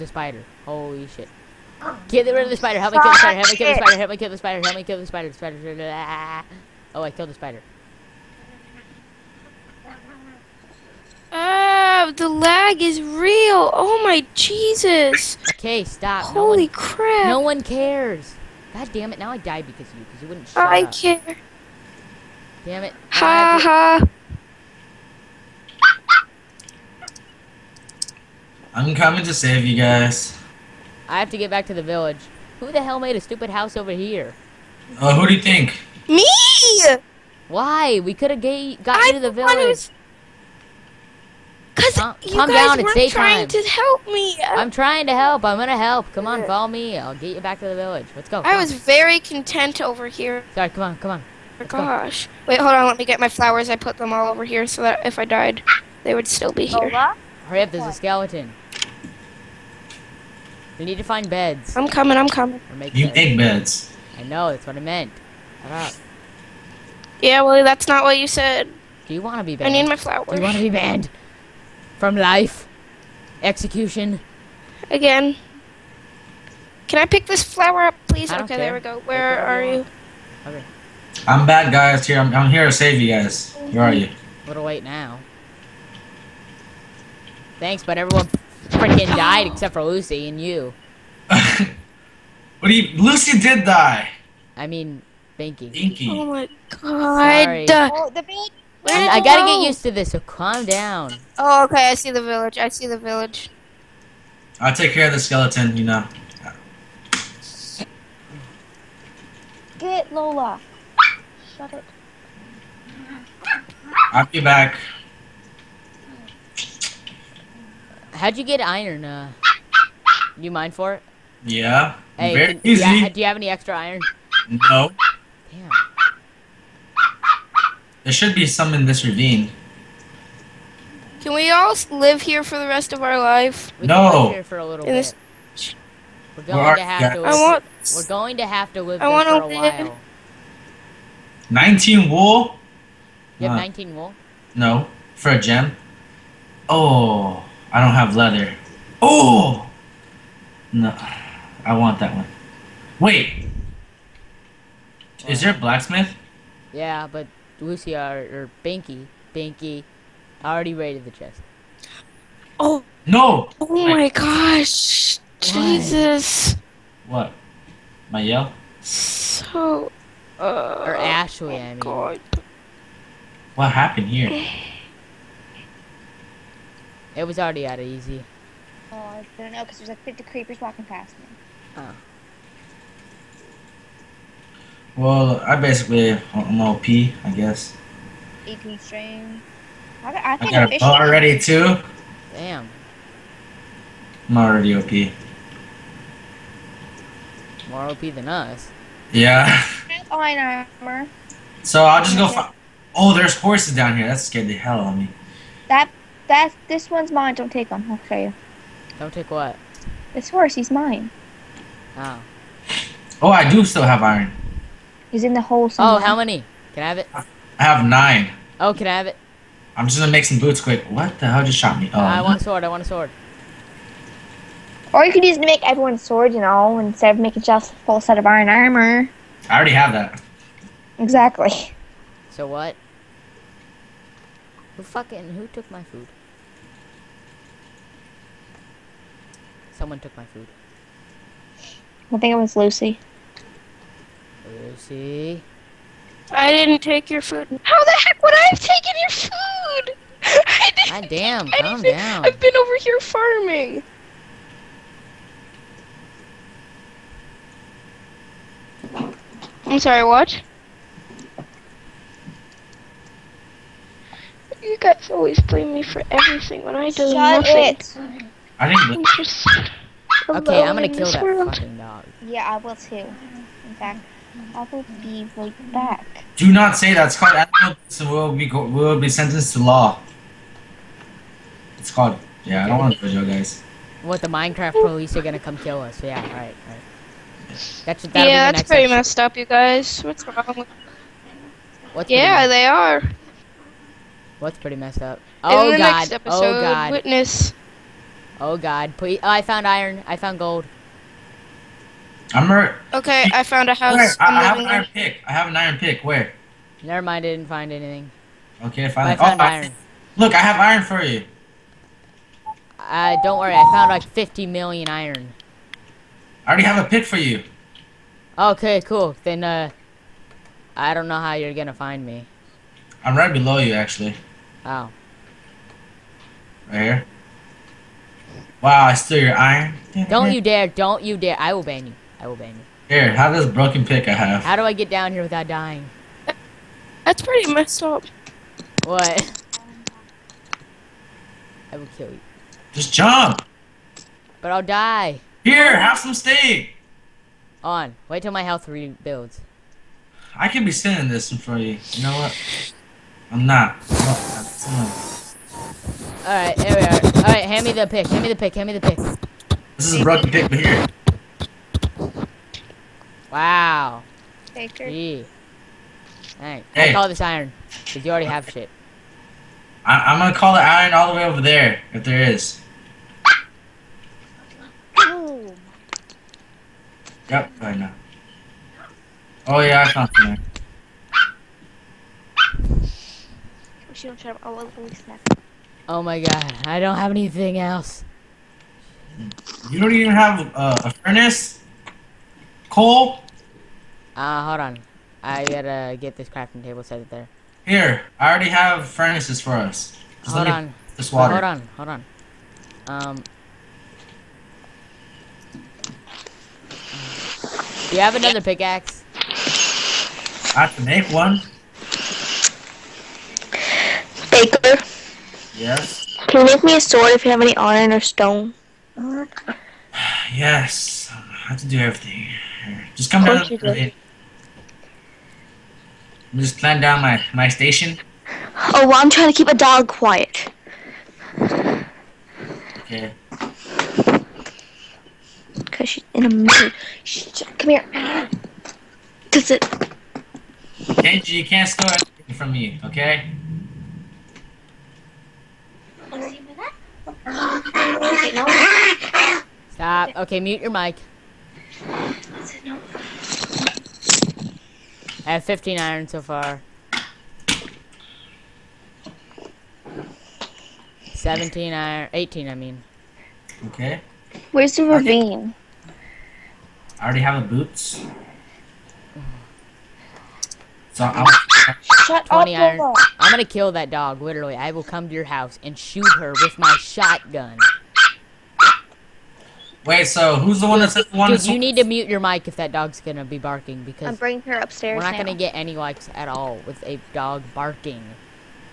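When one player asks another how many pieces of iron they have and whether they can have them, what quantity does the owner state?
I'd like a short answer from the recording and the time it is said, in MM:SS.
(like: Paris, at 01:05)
9, at 03:37.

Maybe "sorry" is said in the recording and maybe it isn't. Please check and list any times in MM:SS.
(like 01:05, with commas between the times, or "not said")
00:50, 01:37, 04:19.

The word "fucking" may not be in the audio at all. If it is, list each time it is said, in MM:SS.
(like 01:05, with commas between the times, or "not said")
03:54, 04:31.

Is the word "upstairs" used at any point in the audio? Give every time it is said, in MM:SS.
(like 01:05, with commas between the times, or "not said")
08:04.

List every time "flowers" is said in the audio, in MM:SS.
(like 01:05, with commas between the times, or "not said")
00:53, 01:09, 01:17.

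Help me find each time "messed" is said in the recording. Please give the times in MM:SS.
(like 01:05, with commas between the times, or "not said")
04:48, 04:54, 05:37.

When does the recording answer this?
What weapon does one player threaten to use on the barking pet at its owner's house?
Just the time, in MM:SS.
07:56.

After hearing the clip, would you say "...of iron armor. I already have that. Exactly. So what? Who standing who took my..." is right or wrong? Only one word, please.
wrong.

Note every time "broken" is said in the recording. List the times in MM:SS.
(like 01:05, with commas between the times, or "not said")
05:33, 06:00.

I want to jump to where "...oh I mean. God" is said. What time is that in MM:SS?
02:51.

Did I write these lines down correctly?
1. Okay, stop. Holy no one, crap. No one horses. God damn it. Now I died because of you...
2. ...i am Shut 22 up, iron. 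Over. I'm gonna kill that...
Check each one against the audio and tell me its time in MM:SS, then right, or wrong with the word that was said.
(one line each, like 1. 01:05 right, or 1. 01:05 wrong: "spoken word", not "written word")
1. 00:15 wrong: "cares", not "horses"
2. 07:51 wrong: "20", not "22".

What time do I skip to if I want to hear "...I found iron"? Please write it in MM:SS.
04:59.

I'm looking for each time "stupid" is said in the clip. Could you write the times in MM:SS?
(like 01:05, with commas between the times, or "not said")
00:33.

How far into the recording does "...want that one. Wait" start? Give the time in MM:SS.
02:31.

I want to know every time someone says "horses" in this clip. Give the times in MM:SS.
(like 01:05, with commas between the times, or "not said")
03:23, 03:30.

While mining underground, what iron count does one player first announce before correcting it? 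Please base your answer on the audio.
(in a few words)
15.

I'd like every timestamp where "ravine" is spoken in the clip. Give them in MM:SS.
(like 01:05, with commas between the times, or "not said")
02:09, 07:44.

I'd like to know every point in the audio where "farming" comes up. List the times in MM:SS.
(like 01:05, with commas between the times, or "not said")
04:12.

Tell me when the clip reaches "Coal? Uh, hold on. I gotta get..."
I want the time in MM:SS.
06:32.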